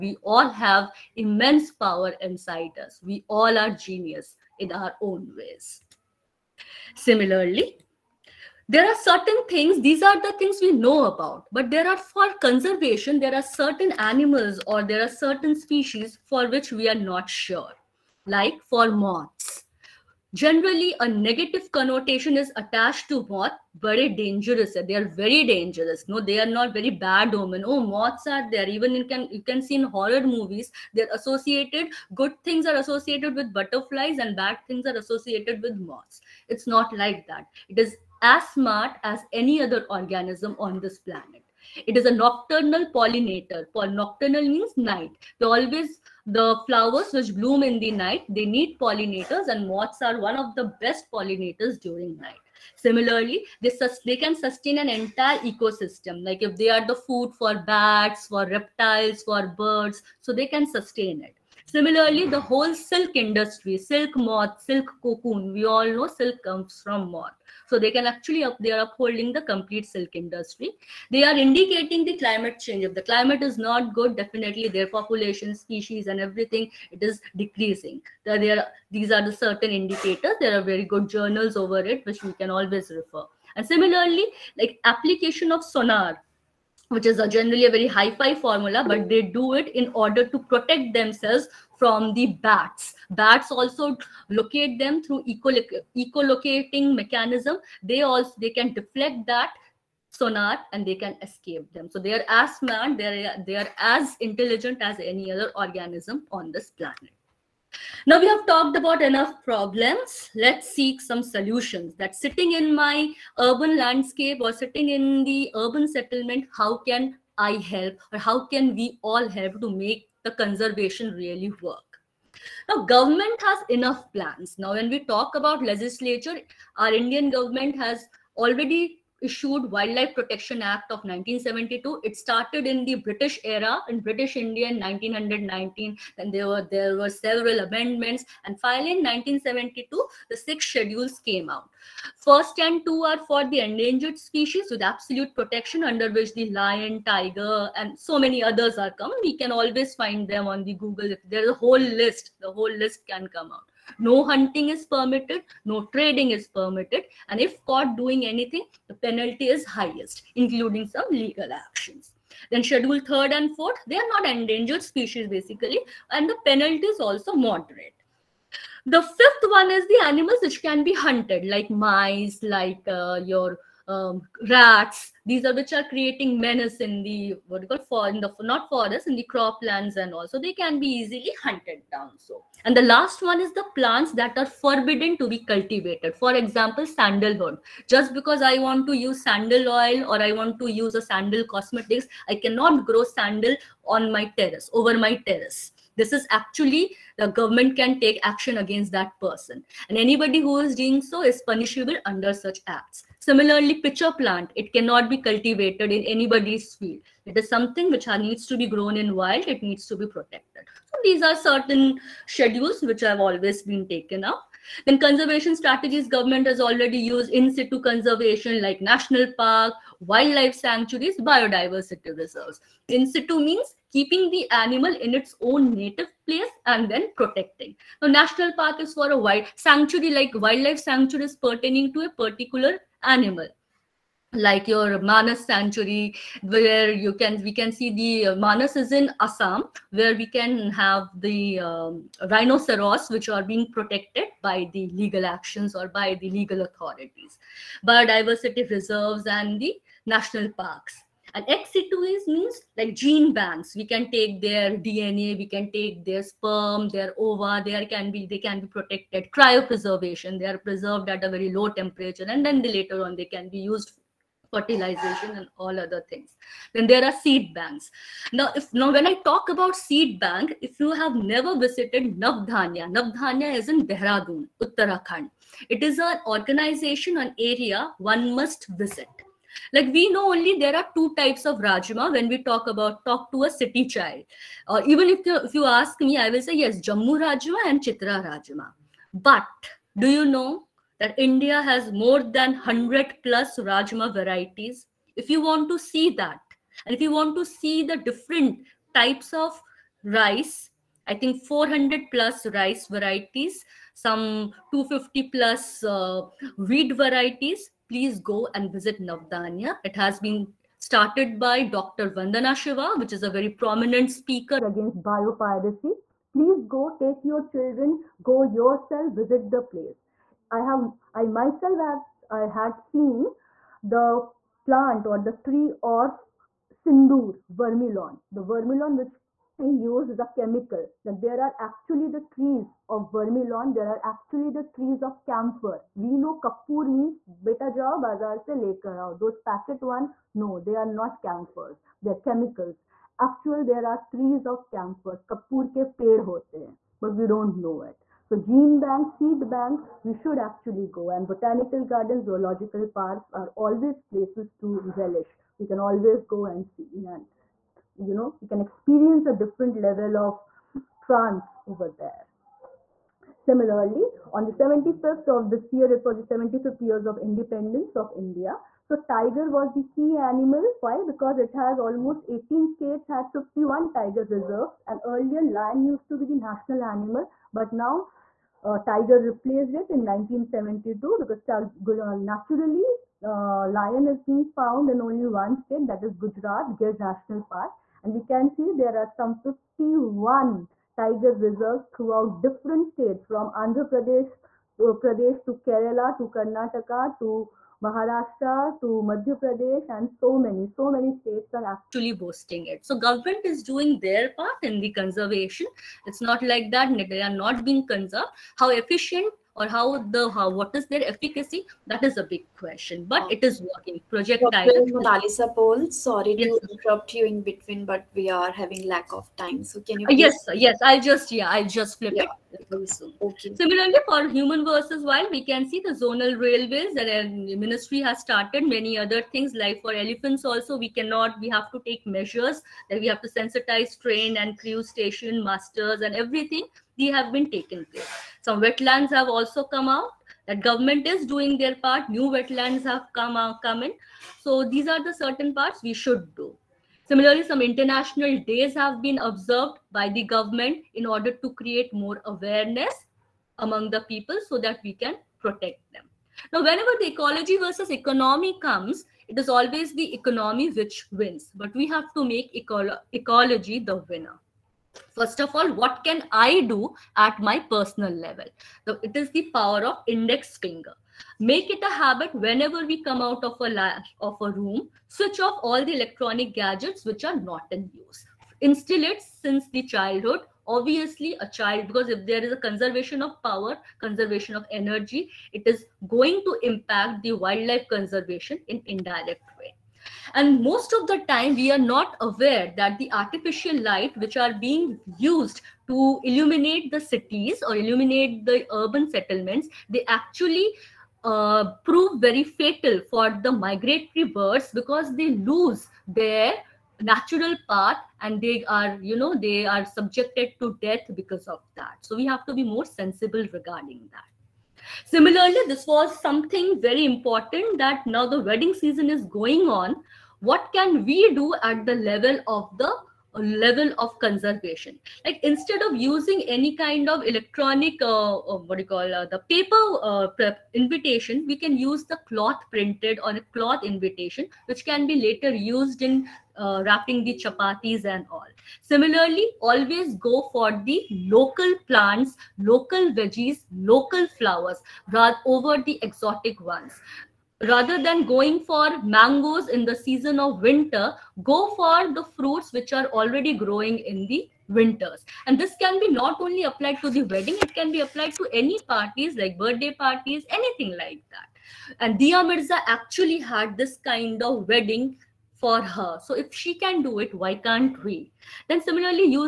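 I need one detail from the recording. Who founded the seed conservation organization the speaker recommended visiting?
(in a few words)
Dr. Vandana Shiva.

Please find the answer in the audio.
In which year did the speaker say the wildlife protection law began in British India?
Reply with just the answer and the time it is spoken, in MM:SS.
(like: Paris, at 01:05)
1919, at 02:14.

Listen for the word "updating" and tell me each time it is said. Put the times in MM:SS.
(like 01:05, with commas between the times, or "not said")
not said.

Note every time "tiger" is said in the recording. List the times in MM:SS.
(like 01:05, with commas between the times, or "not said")
02:27, 06:09, 06:13, 06:18, 06:30.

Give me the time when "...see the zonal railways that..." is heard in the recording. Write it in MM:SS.
07:05.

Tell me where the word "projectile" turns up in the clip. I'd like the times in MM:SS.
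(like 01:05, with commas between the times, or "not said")
06:54.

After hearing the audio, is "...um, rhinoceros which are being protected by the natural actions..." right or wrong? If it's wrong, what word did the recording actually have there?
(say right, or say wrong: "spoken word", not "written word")
wrong: "legal", not "natural".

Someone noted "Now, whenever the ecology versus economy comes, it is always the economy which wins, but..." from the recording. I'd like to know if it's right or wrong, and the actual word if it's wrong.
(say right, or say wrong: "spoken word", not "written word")
right.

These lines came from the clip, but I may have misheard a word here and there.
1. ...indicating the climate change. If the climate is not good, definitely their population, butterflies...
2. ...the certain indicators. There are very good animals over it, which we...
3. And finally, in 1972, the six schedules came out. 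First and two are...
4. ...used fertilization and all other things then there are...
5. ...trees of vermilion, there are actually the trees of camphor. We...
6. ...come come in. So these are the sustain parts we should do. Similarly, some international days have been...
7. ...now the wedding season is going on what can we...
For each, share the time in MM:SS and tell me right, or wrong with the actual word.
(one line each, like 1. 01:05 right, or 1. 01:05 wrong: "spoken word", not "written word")
1. 01:11 wrong: "species", not "butterflies"
2. 01:19 wrong: "journals", not "animals"
3. 02:18 right
4. 04:23 right
5. 05:32 right
6. 07:23 wrong: "certain", not "sustain"
7. 08:38 right.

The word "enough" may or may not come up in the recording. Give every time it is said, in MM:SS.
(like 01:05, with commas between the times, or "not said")
01:49, 02:03.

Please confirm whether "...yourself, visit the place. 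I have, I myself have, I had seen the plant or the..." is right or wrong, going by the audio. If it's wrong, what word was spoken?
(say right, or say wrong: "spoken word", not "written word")
right.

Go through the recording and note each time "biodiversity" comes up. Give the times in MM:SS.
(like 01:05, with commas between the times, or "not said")
03:41, 04:07.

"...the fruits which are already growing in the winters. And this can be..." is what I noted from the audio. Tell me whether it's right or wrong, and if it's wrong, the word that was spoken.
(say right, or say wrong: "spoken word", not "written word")
right.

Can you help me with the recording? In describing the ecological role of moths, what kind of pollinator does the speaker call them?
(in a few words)
Nocturnal pollinator.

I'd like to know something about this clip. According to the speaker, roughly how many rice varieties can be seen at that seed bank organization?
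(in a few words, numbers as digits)
400+.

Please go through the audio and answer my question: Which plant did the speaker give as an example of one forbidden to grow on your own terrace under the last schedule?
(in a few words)
Sandalwood.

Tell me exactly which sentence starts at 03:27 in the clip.
It is something which needs to be grown in wild, it needs to be protected.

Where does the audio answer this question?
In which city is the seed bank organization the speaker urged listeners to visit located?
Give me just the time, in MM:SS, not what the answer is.
04:33.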